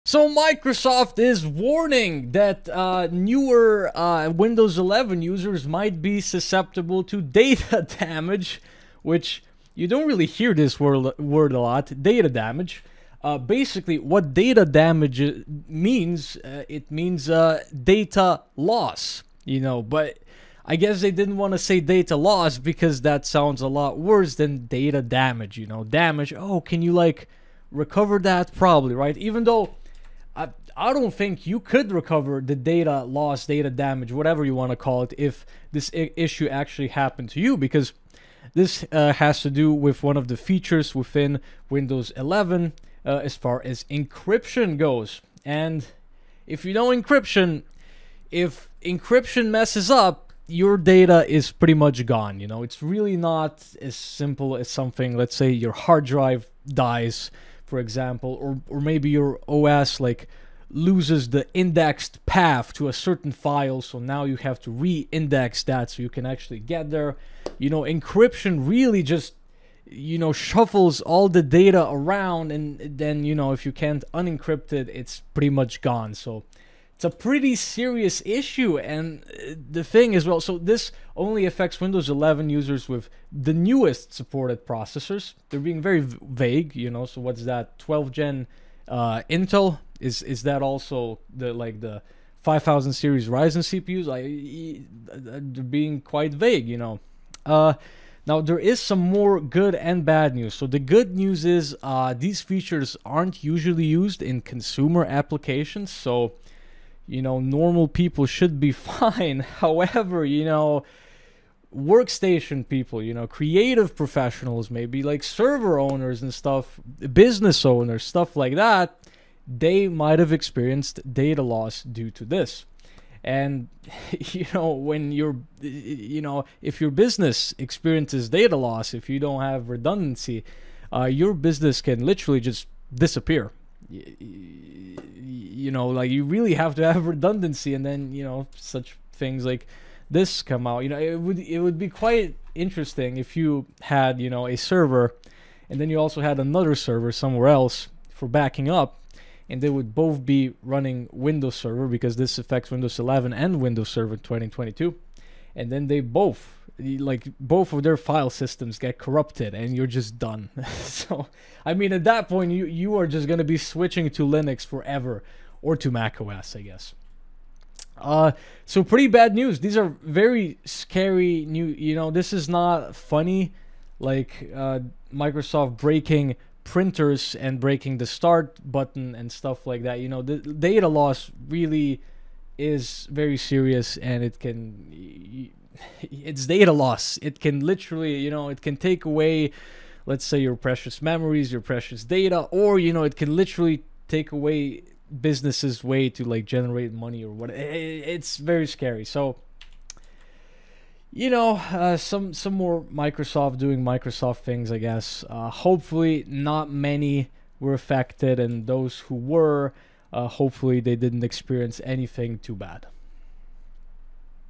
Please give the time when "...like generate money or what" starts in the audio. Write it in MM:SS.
03:16.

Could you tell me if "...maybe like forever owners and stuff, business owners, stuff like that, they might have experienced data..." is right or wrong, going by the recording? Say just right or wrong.
wrong.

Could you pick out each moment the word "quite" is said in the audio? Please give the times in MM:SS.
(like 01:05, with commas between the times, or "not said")
01:36, 02:21.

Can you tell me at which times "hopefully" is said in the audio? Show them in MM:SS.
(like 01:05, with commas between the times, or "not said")
03:25, 03:30.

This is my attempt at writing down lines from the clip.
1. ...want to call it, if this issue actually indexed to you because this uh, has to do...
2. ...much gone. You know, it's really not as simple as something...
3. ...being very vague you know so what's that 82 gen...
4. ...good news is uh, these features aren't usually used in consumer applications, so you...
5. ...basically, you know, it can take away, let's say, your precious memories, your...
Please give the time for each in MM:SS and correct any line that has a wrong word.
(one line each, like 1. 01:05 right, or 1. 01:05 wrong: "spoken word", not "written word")
1. 00:34 wrong: "happened", not "indexed"
2. 00:51 right
3. 01:25 wrong: "12", not "82"
4. 01:40 right
5. 03:07 wrong: "literally", not "basically".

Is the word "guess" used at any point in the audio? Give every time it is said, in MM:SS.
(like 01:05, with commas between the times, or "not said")
00:20, 02:46, 03:24.